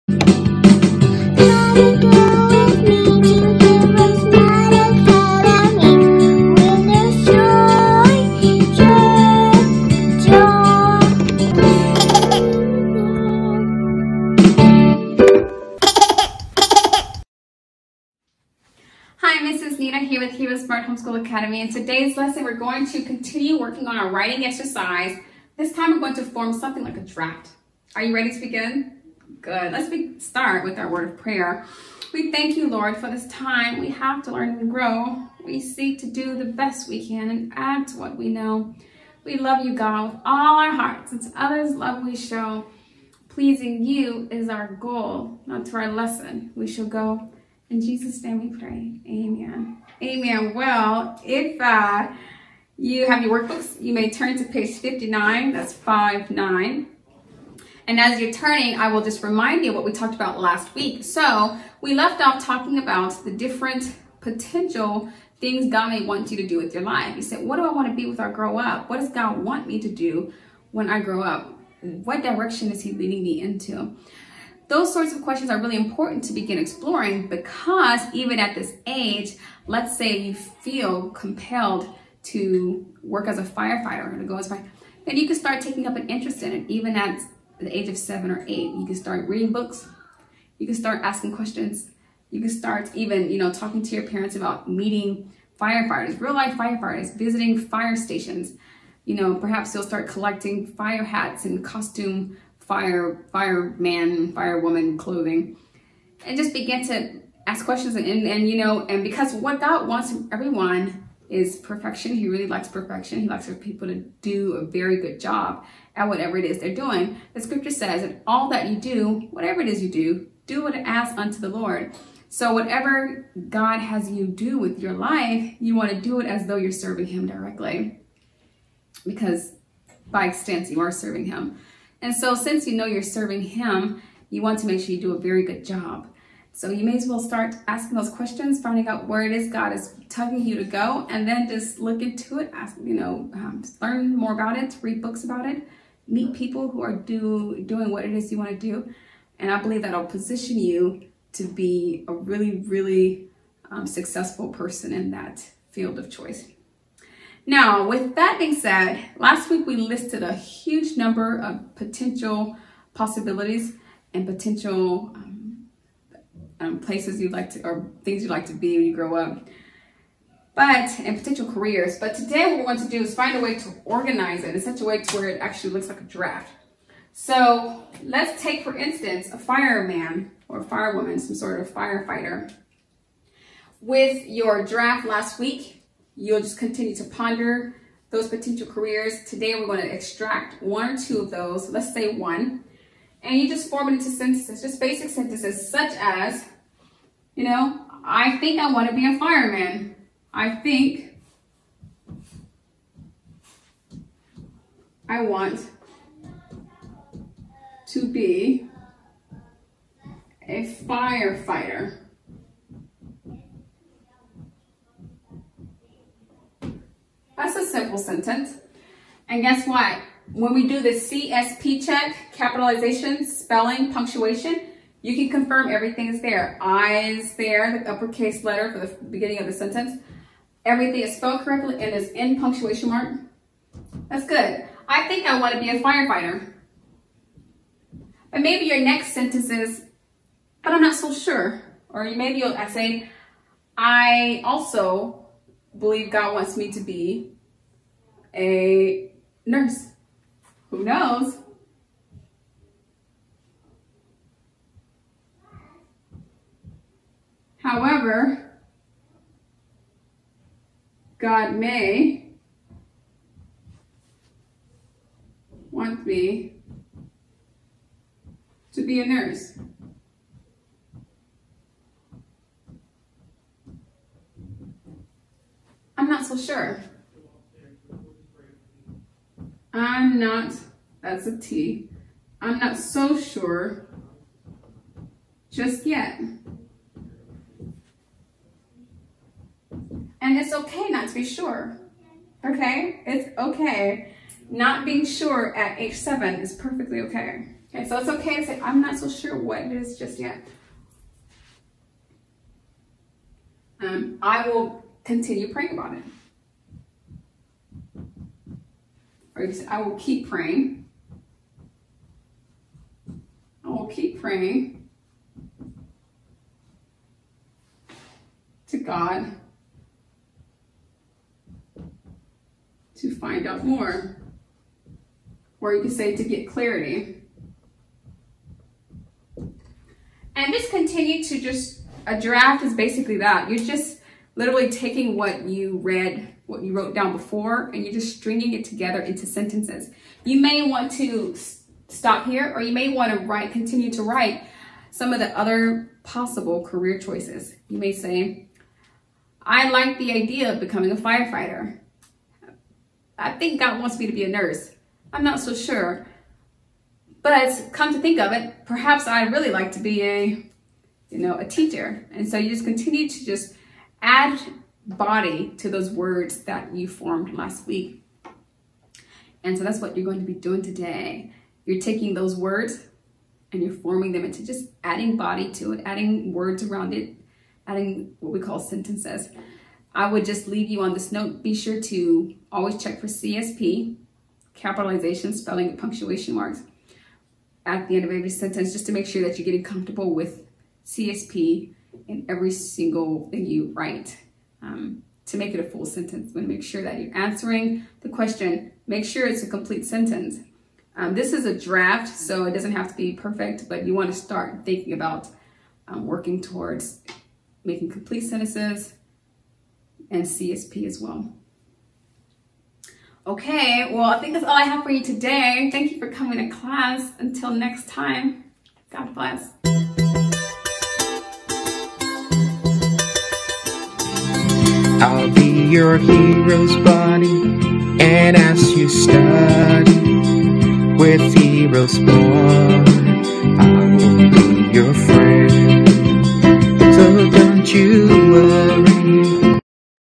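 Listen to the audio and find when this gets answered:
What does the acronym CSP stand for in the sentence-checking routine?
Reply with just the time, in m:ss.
3:42.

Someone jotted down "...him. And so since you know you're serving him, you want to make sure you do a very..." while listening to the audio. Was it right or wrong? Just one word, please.
right.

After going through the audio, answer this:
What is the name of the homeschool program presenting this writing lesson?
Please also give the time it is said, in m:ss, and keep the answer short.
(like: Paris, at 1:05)
Smart Homeschool Academy, at 0:20.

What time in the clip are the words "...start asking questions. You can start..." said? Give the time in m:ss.
1:30.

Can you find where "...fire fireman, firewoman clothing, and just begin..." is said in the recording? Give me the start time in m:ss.
1:42.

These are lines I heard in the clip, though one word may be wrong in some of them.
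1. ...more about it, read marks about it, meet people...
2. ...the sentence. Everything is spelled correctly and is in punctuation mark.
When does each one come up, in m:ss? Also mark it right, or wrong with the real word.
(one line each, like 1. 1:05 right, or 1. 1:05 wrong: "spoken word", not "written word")
1. 2:24 wrong: "books", not "marks"
2. 3:49 right.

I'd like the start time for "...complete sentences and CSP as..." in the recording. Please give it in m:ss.
6:47.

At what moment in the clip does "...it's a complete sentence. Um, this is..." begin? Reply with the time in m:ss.
6:39.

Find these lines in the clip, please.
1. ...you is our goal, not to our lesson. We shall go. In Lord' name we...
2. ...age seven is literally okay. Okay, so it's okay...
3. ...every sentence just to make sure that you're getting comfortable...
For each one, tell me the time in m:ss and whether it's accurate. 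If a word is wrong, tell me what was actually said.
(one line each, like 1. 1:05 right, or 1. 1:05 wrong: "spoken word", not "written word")
1. 0:43 wrong: "Jesus", not "Lord"
2. 4:55 wrong: "perfectly", not "literally"
3. 6:28 right.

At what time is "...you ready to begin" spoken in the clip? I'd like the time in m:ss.
0:28.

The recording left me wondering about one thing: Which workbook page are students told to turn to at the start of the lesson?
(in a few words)
59.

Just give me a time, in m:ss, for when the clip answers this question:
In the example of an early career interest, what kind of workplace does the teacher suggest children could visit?
1:37.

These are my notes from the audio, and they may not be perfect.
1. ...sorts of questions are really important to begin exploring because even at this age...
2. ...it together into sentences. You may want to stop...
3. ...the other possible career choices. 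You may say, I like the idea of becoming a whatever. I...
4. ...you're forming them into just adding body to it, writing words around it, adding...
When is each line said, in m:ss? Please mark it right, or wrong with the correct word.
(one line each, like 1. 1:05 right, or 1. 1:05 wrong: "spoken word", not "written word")
1. 1:14 right
2. 5:38 right
3. 5:45 wrong: "firefighter", not "whatever"
4. 6:13 wrong: "adding", not "writing".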